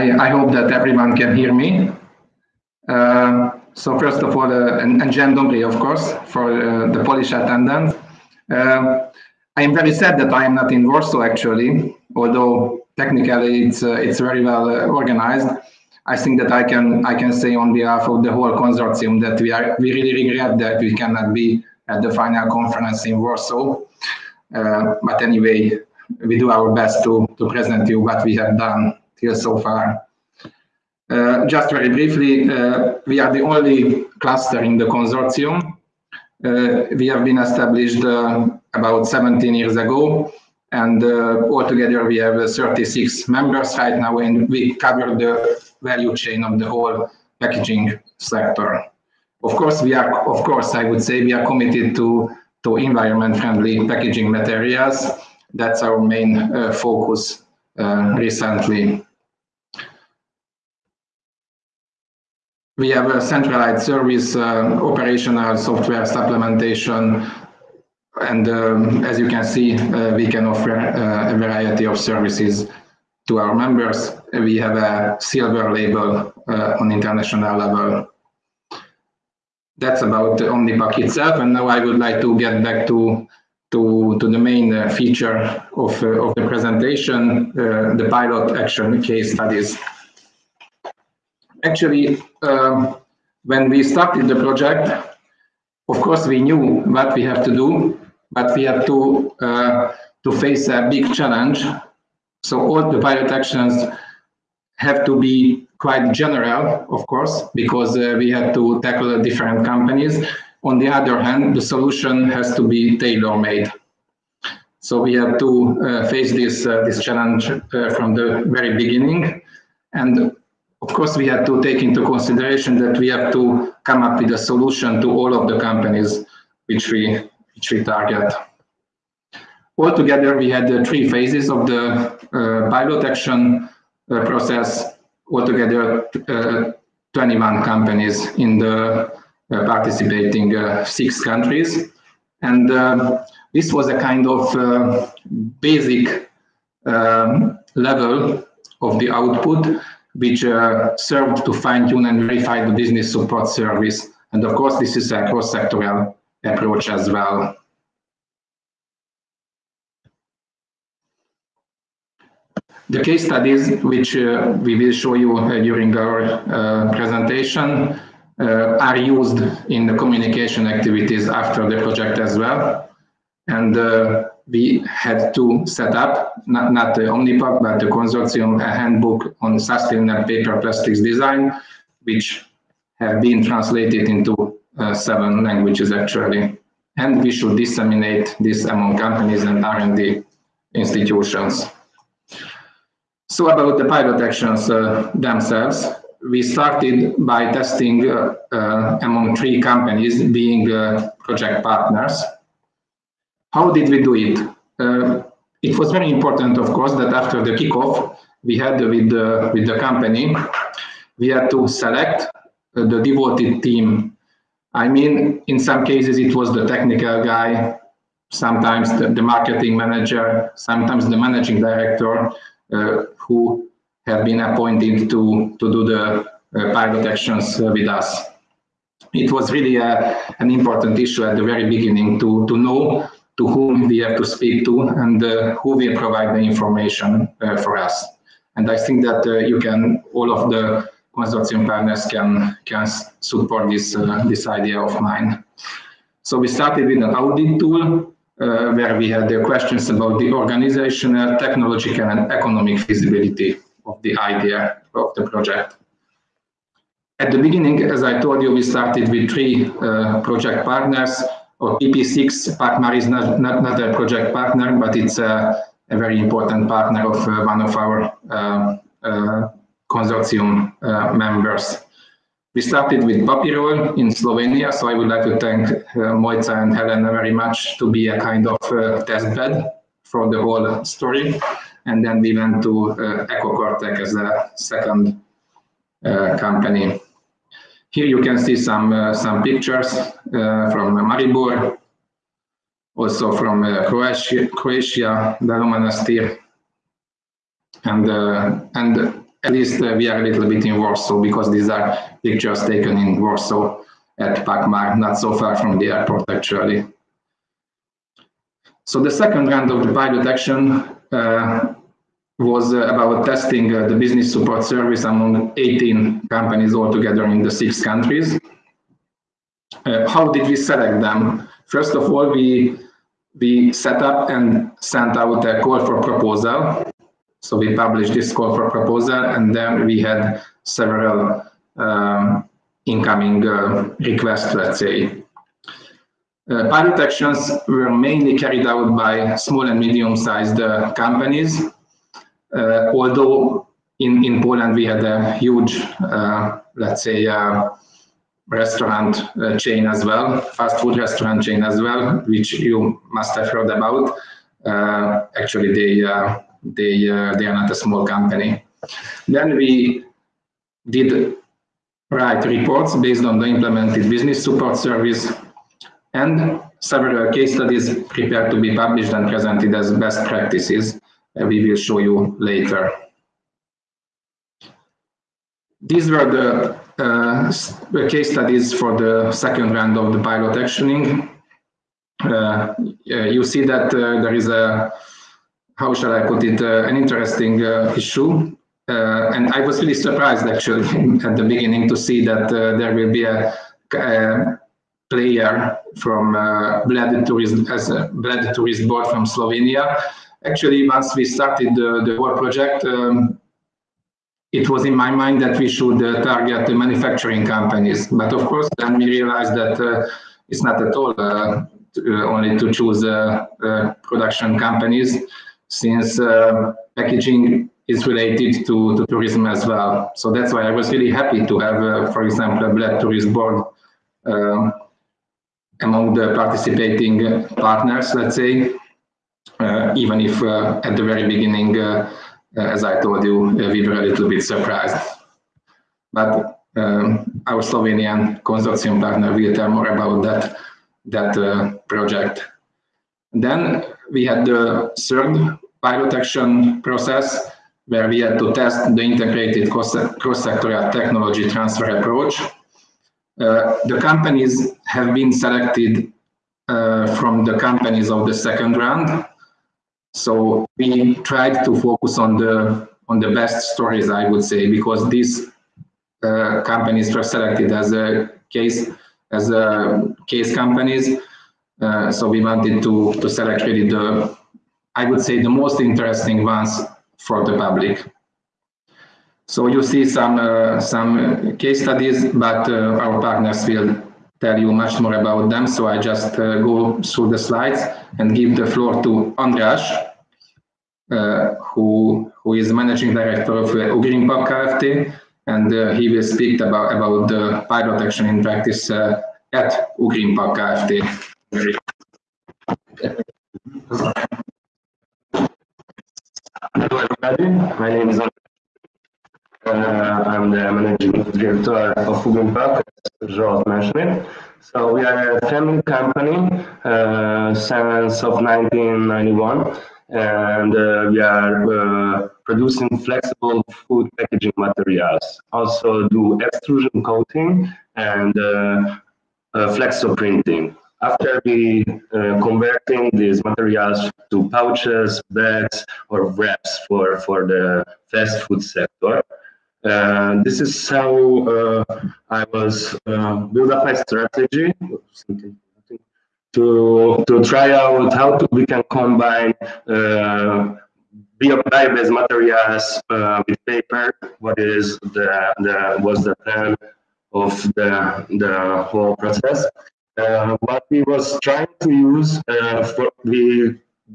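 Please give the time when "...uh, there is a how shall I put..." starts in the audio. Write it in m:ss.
6:23.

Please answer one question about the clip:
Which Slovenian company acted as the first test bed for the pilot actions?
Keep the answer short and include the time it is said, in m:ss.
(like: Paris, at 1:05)
Papirol, at 4:33.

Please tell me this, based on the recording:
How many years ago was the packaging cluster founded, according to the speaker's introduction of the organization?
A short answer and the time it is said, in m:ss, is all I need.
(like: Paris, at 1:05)
17, at 0:39.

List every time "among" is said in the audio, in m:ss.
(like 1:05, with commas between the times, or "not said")
3:08, 3:19, 5:15, 7:05.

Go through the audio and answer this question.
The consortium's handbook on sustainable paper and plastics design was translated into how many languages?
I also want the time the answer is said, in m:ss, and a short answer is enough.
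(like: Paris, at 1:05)
7, at 3:04.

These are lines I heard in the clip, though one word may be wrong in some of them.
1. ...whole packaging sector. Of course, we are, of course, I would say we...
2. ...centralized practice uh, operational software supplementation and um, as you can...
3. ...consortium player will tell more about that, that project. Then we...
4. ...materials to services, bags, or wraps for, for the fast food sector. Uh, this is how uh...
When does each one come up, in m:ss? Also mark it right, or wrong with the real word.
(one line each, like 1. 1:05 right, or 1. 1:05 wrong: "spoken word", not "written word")
1. 0:46 right
2. 1:03 wrong: "service", not "practice"
3. 7:18 wrong: "partner", not "player"
4. 8:53 wrong: "pouches", not "services".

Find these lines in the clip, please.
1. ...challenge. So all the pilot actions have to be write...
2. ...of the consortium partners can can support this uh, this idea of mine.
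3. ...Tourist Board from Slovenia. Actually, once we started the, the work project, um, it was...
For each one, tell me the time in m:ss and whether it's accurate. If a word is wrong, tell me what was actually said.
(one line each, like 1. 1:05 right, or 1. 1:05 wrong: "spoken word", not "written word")
1. 1:41 wrong: "quite", not "write"
2. 4:00 right
3. 6:38 right.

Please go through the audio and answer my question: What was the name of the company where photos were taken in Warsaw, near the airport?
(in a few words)
Pakmar.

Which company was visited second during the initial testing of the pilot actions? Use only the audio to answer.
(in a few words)
EcoCortec.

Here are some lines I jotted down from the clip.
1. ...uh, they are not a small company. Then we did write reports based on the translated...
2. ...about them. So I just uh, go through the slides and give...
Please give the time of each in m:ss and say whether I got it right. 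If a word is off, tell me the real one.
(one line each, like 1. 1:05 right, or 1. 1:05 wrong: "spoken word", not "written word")
1. 5:57 wrong: "implemented", not "translated"
2. 8:05 right.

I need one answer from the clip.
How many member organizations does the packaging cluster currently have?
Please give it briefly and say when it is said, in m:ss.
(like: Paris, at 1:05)
36, at 0:42.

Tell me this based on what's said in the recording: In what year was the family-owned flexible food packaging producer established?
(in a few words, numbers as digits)
1991.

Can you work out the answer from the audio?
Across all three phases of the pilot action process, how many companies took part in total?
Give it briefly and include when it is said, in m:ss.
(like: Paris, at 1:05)
21, at 2:17.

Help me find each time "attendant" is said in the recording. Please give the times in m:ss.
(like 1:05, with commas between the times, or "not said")
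0:07.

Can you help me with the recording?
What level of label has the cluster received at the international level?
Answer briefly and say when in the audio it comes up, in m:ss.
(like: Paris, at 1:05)
Silver, at 1:15.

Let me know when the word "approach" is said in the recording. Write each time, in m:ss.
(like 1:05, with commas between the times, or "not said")
2:36, 7:31.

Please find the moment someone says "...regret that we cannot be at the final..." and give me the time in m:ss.
0:20.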